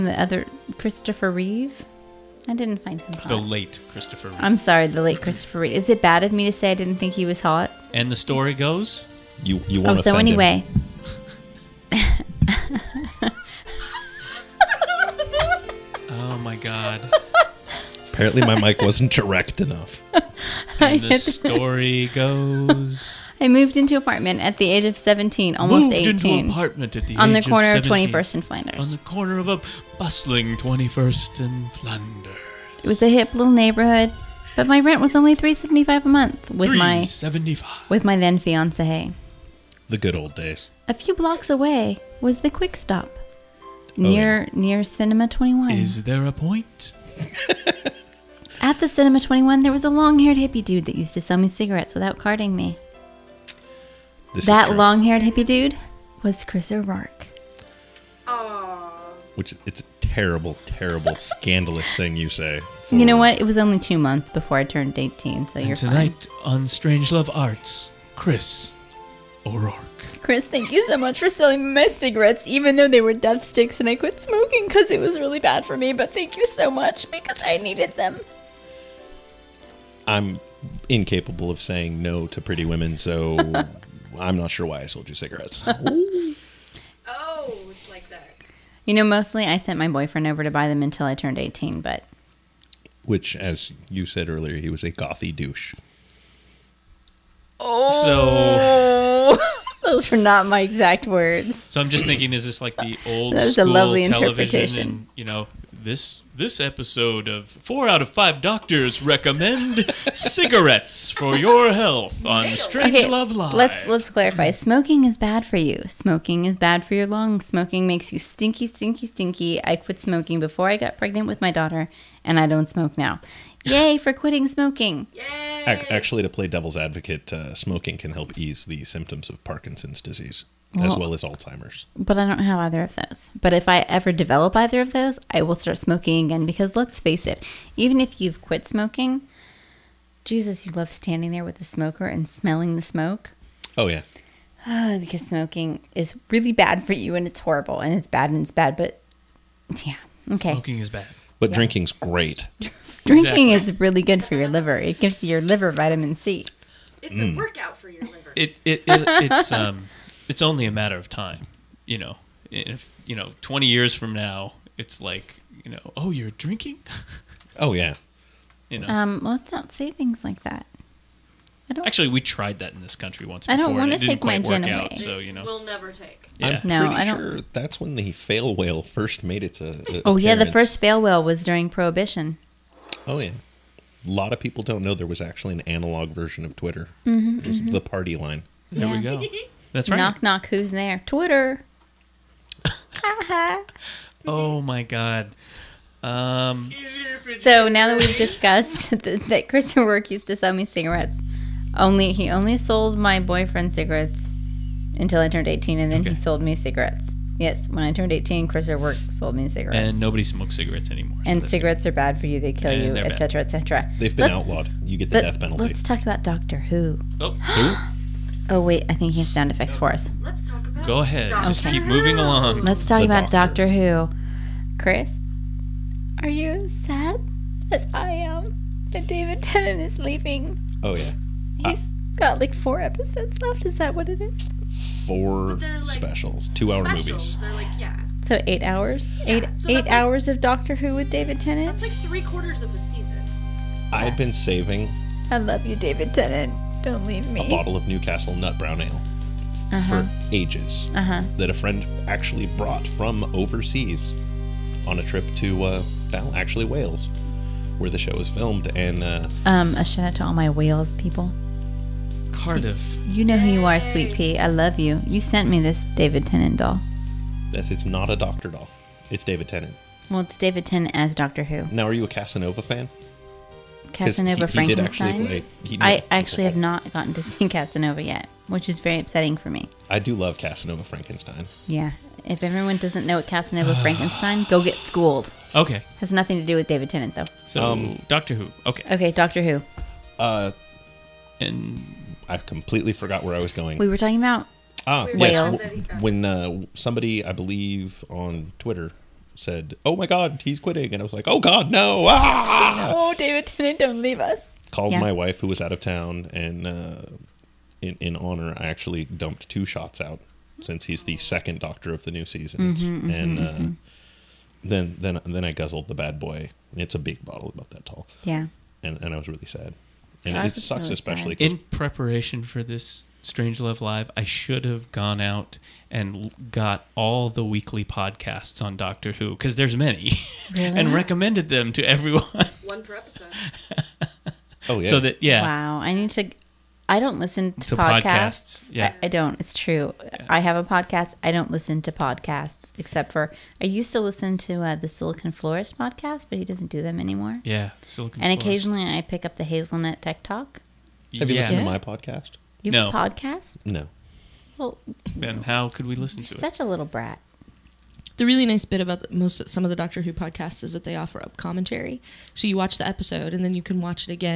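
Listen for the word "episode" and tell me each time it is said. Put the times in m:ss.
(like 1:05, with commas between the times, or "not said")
1:46, 3:52, 5:32, 6:02.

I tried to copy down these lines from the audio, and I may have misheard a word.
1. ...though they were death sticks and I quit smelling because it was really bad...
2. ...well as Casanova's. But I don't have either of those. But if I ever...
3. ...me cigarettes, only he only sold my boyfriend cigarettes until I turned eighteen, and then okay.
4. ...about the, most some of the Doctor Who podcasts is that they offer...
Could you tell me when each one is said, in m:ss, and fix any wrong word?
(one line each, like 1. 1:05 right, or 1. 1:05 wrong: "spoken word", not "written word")
1. 1:12 wrong: "smoking", not "smelling"
2. 2:10 wrong: "Alzheimer", not "Casanova"
3. 3:20 right
4. 5:58 right.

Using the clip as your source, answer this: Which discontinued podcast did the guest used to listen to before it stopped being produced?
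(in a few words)
Silicon Florist.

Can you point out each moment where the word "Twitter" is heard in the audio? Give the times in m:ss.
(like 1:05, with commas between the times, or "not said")
3:06, 3:11, 4:58.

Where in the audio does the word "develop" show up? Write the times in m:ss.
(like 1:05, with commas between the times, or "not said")
2:14.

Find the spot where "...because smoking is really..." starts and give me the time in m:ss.
2:24.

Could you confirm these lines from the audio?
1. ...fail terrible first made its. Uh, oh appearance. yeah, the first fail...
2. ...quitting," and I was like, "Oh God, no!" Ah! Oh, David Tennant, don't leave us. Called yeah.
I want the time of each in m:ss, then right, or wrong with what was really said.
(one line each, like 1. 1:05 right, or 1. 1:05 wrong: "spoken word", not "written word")
1. 2:58 wrong: "whale", not "terrible"
2. 5:00 right.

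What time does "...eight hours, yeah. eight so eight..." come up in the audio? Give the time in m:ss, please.
3:58.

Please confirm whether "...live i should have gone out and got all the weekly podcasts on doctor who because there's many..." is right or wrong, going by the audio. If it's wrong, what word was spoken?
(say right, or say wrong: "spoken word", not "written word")
right.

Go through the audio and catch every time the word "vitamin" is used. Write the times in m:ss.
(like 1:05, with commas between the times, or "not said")
2:35.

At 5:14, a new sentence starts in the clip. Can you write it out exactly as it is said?
then, then, then I guzzled the bad boy.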